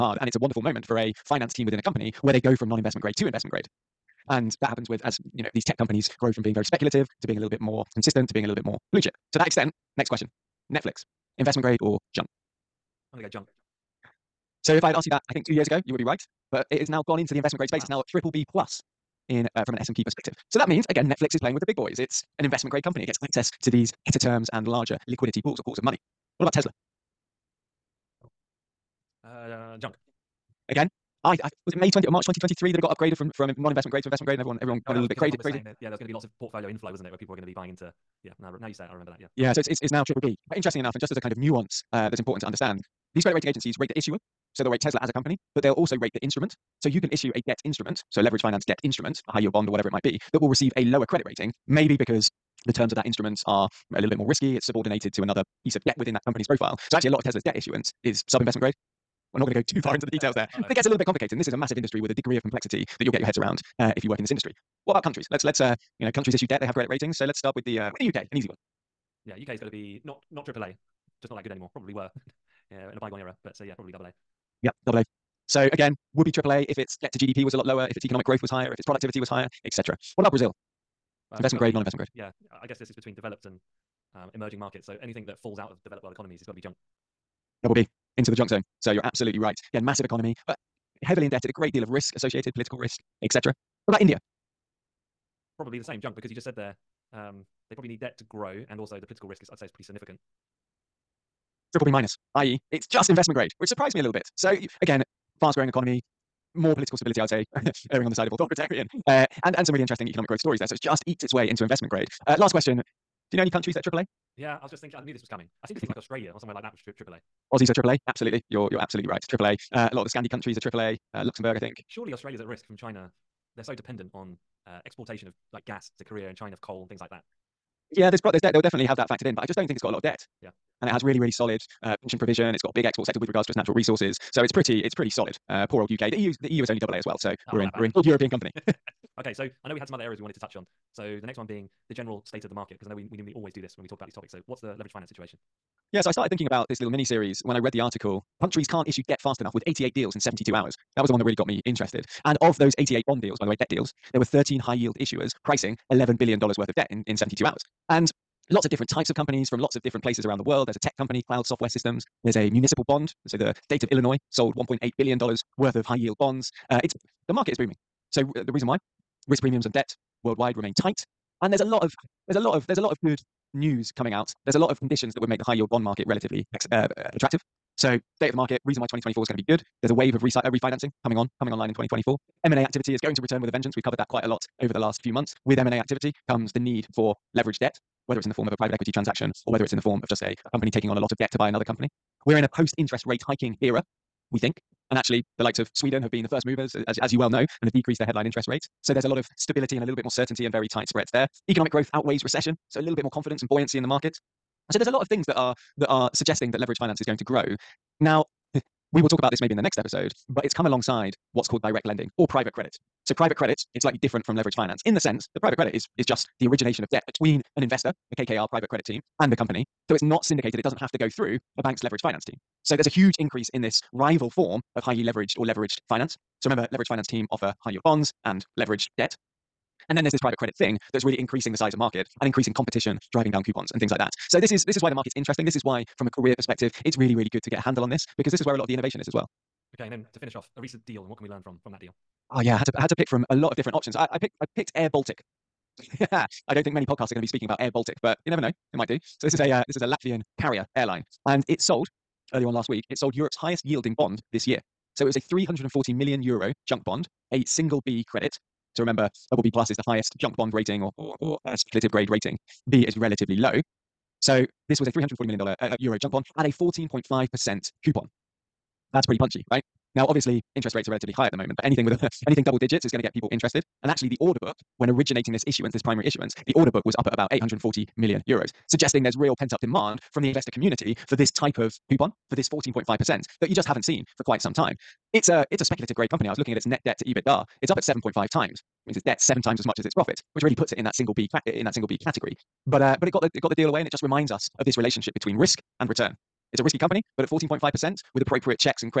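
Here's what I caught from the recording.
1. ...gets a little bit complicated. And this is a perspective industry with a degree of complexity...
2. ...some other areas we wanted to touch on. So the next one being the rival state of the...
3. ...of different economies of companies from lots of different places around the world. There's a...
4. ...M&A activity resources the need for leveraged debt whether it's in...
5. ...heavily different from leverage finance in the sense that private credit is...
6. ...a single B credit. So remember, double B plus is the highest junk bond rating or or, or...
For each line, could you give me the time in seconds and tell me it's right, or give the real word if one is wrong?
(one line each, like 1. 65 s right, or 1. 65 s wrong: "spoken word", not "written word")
1. 60 s wrong: "massive", not "perspective"
2. 139 s wrong: "general", not "rival"
3. 158 s wrong: "types", not "economies"
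4. 185 s wrong: "comes", not "resources"
5. 213 s wrong: "slightly", not "heavily"
6. 257 s right.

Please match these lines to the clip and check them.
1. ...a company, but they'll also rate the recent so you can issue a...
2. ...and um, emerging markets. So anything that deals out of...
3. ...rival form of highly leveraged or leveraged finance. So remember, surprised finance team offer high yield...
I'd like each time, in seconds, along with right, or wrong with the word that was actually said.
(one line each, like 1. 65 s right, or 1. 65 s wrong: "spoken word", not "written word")
1. 45 s wrong: "instrument", not "recent"
2. 83 s wrong: "falls", not "deals"
3. 223 s wrong: "leveraged", not "surprised".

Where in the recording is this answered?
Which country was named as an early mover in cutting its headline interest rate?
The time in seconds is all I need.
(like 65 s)
195 s.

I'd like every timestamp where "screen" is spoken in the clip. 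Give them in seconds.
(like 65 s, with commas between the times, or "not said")
not said.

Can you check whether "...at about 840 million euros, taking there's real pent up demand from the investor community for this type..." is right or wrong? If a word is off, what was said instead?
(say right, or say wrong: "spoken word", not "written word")
wrong: "suggesting", not "taking".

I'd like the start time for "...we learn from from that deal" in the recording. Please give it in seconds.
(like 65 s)
241 s.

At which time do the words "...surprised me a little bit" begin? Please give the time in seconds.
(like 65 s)
103 s.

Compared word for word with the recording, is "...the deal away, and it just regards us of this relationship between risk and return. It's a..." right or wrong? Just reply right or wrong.
wrong.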